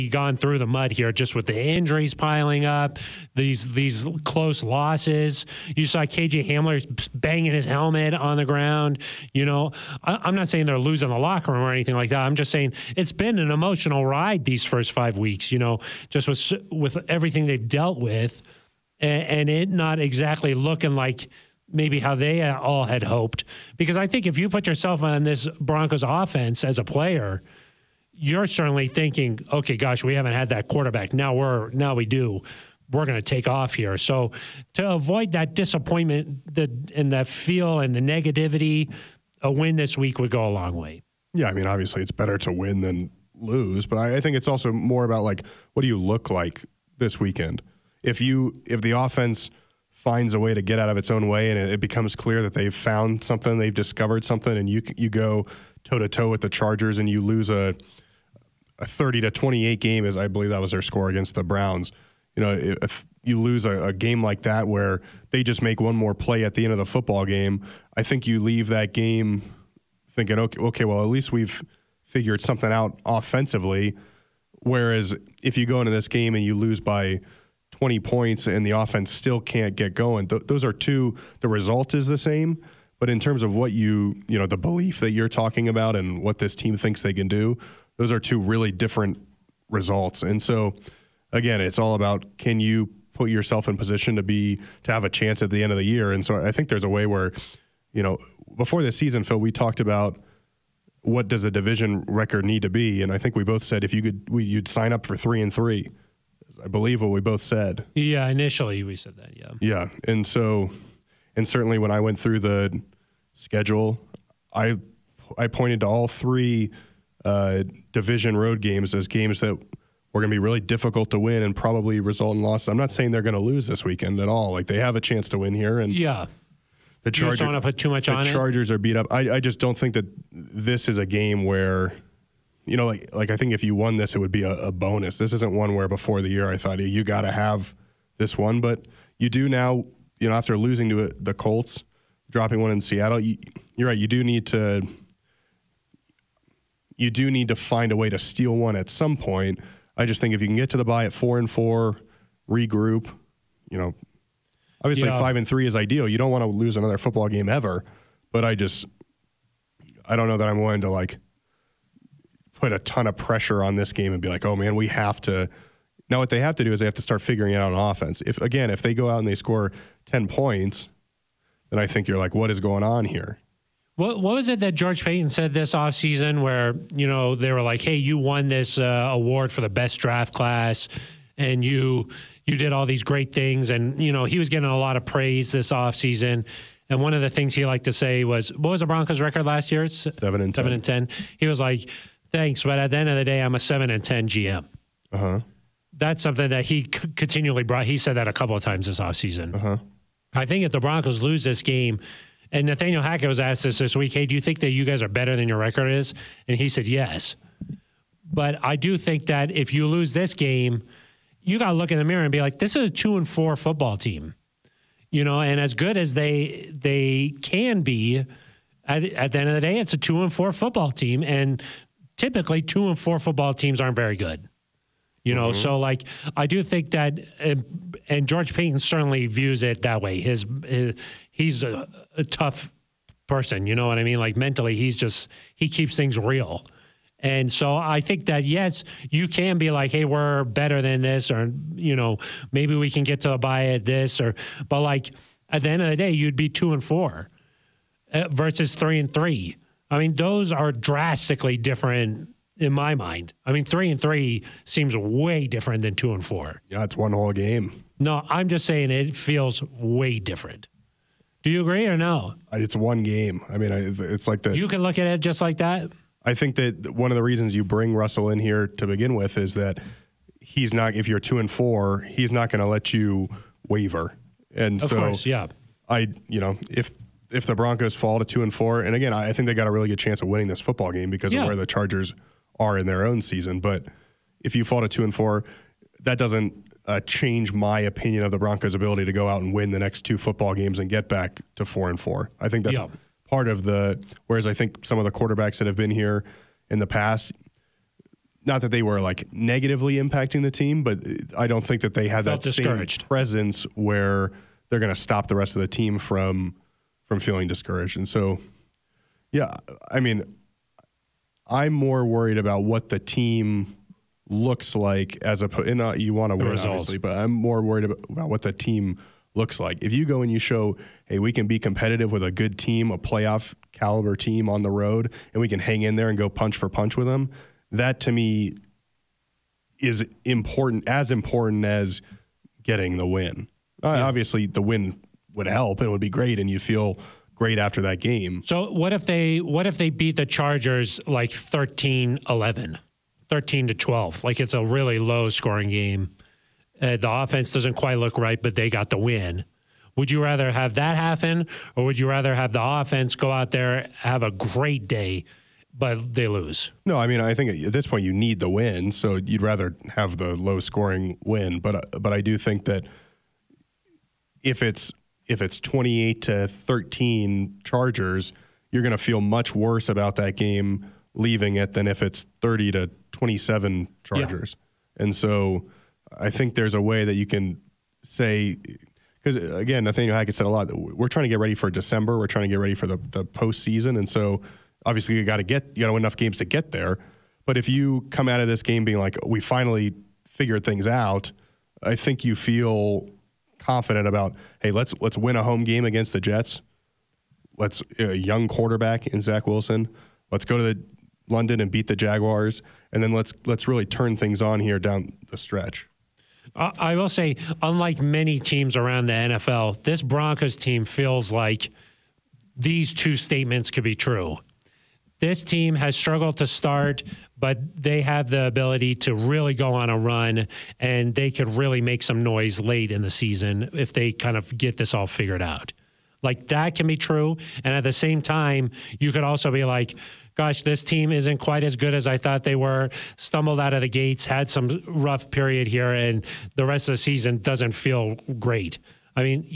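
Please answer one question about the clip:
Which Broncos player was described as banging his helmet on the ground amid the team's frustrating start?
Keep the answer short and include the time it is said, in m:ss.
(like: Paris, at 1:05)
KJ Hamler, at 0:06.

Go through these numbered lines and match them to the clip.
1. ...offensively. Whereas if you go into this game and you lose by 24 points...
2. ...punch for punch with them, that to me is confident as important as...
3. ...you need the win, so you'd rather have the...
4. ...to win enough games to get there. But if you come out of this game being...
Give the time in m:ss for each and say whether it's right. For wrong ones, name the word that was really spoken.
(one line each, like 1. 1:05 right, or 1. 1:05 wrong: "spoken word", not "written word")
1. 1:13 wrong: "20", not "24"
2. 5:26 wrong: "important", not "confident"
3. 5:58 right
4. 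6:25 right.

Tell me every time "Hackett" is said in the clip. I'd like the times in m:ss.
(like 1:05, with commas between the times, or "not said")
3:23, 6:20.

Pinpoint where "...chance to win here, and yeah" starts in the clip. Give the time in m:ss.
2:05.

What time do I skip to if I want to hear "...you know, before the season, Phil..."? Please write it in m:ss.
1:37.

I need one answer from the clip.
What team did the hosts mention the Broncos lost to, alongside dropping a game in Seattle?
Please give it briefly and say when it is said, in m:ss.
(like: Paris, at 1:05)
the Colts, at 2:21.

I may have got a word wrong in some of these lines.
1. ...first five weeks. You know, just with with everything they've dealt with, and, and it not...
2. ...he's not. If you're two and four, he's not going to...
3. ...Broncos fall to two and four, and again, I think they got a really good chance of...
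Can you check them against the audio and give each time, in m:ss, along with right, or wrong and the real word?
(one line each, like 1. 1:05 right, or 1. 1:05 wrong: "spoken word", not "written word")
1. 0:14 right
2. 4:30 right
3. 4:37 right.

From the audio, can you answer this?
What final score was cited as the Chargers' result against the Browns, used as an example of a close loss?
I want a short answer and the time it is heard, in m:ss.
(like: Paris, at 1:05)
30 to 28, at 0:58.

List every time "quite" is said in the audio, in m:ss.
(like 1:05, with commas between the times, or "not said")
5:47, 7:11.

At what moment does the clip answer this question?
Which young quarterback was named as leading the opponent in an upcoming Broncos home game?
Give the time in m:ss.
6:39.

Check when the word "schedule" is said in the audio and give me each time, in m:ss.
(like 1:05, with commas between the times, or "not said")
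1:53.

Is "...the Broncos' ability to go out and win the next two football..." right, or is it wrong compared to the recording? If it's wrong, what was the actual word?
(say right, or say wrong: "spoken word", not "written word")
right.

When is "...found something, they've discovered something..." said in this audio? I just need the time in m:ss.
0:52.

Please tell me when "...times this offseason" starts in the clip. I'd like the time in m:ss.
3:18.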